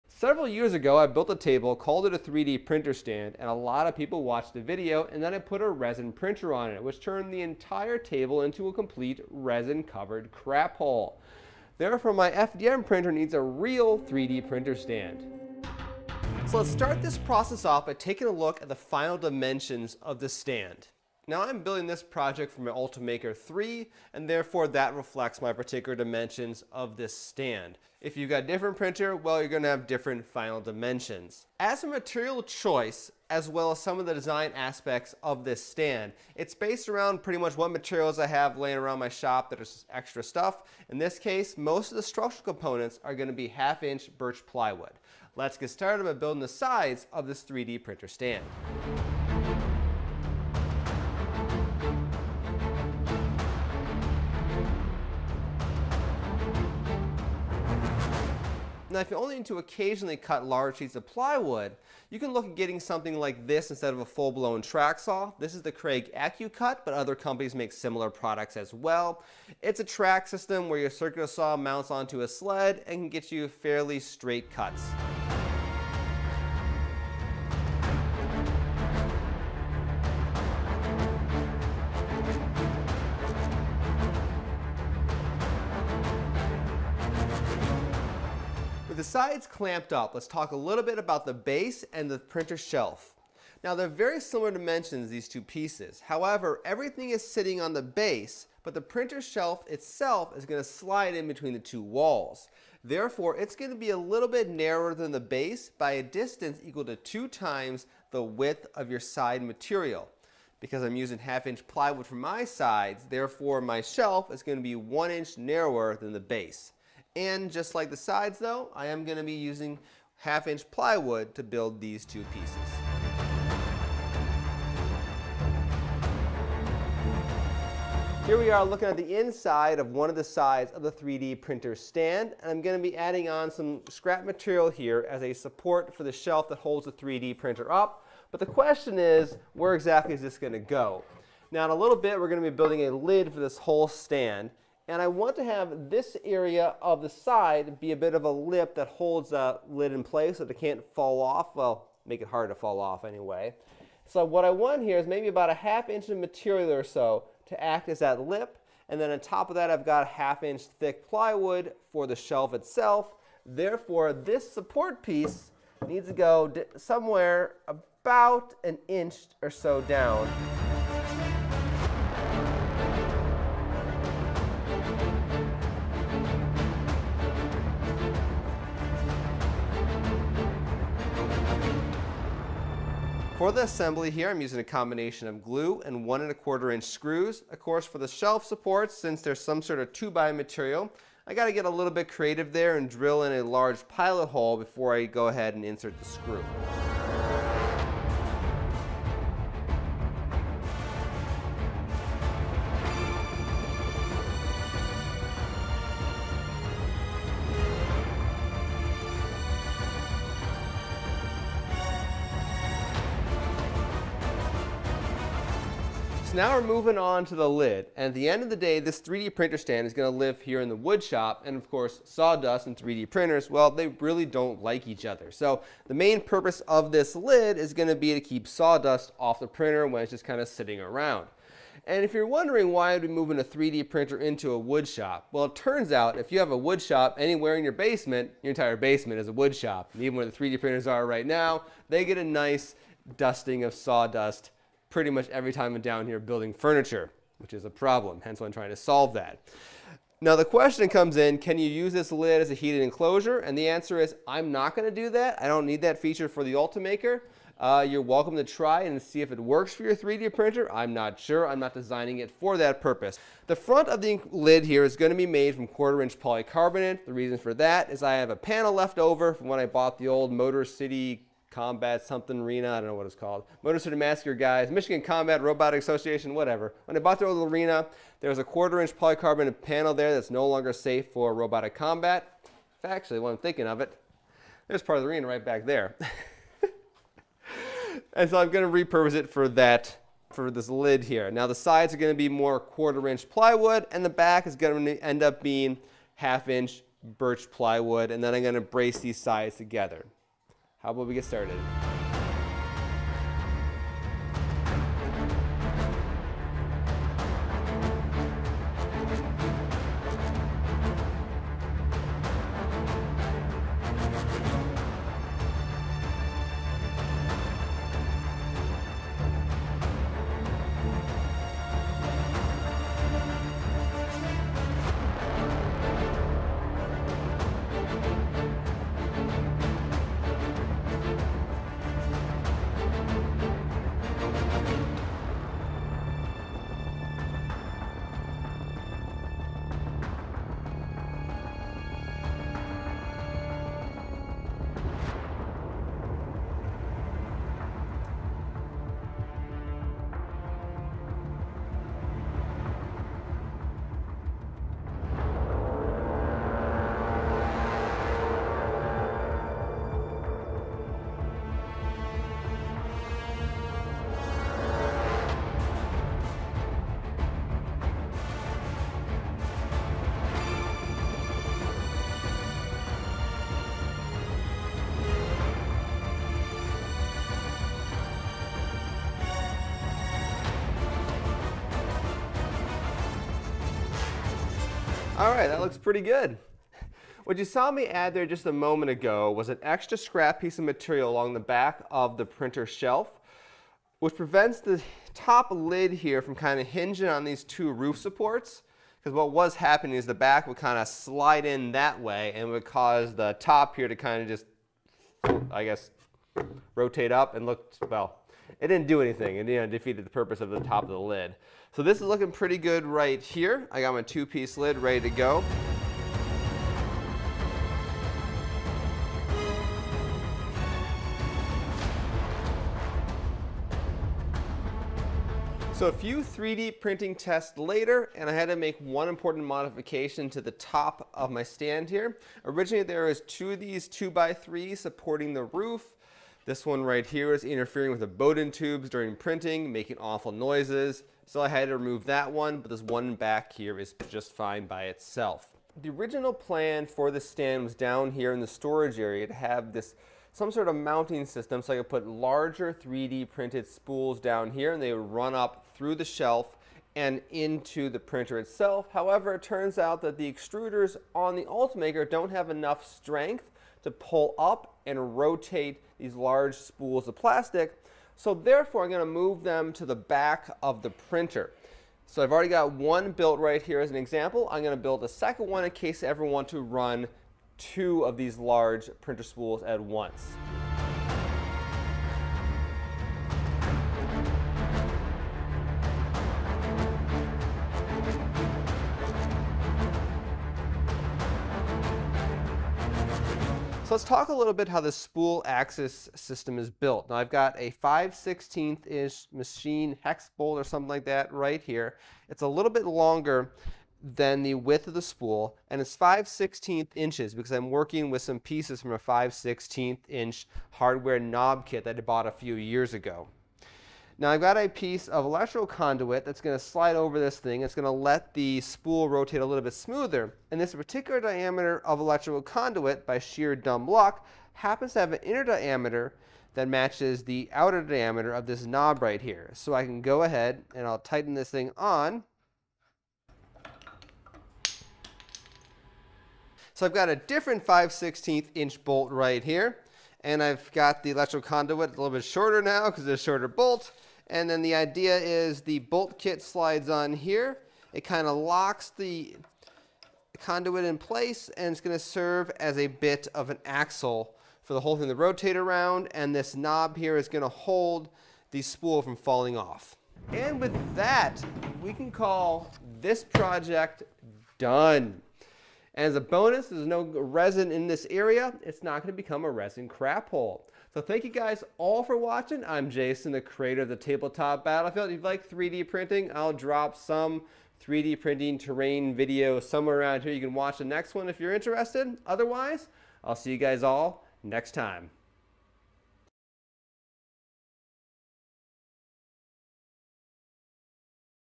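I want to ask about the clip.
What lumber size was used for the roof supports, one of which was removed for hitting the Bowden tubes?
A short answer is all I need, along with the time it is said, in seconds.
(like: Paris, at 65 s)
2x3, at 433 s.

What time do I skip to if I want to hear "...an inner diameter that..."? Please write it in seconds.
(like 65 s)
525 s.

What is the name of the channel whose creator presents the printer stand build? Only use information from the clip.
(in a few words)
Tabletop Battlefield.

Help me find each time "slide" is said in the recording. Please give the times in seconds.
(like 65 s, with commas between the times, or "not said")
100 s, 400 s, 516 s, 546 s.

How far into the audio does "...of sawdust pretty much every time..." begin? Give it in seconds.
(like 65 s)
243 s.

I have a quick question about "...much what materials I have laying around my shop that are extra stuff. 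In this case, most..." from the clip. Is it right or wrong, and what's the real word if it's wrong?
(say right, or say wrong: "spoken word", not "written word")
right.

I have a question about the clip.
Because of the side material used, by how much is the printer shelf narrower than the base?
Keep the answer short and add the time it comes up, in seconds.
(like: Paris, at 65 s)
1 inch, at 114 s.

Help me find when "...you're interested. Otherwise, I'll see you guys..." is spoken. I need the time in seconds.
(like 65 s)
581 s.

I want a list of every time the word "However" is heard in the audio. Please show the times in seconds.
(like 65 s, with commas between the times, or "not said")
96 s, 458 s.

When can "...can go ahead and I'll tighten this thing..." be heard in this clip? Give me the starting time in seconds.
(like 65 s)
529 s.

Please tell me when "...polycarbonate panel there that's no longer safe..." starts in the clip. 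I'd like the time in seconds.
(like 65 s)
278 s.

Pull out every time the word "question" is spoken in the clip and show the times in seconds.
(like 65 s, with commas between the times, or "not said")
138 s, 250 s.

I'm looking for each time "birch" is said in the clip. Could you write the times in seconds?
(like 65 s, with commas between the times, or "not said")
44 s, 297 s.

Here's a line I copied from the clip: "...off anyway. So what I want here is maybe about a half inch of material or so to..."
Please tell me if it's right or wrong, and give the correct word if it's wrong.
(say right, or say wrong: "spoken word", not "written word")
right.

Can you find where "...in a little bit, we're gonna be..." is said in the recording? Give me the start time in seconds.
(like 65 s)
141 s.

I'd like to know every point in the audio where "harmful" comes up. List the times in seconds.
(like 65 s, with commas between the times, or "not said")
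not said.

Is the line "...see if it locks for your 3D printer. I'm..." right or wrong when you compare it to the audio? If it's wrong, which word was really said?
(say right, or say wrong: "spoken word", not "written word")
wrong: "works", not "locks".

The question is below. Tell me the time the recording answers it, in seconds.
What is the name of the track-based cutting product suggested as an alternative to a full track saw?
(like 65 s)
65 s.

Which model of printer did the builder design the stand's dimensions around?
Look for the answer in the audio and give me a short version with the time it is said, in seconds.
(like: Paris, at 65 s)
Ultimaker 3, at 22 s.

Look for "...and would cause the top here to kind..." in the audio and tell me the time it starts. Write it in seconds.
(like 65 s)
402 s.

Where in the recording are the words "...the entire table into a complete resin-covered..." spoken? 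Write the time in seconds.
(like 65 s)
7 s.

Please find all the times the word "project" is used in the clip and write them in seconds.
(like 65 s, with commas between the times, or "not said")
22 s, 563 s.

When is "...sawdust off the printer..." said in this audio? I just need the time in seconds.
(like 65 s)
228 s.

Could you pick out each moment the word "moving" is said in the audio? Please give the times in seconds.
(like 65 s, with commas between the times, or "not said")
216 s, 233 s.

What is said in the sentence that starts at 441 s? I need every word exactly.
So I had to remove that one, but this one back here is just fine by itself.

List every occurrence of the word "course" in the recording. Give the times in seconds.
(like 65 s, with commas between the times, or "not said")
187 s, 221 s.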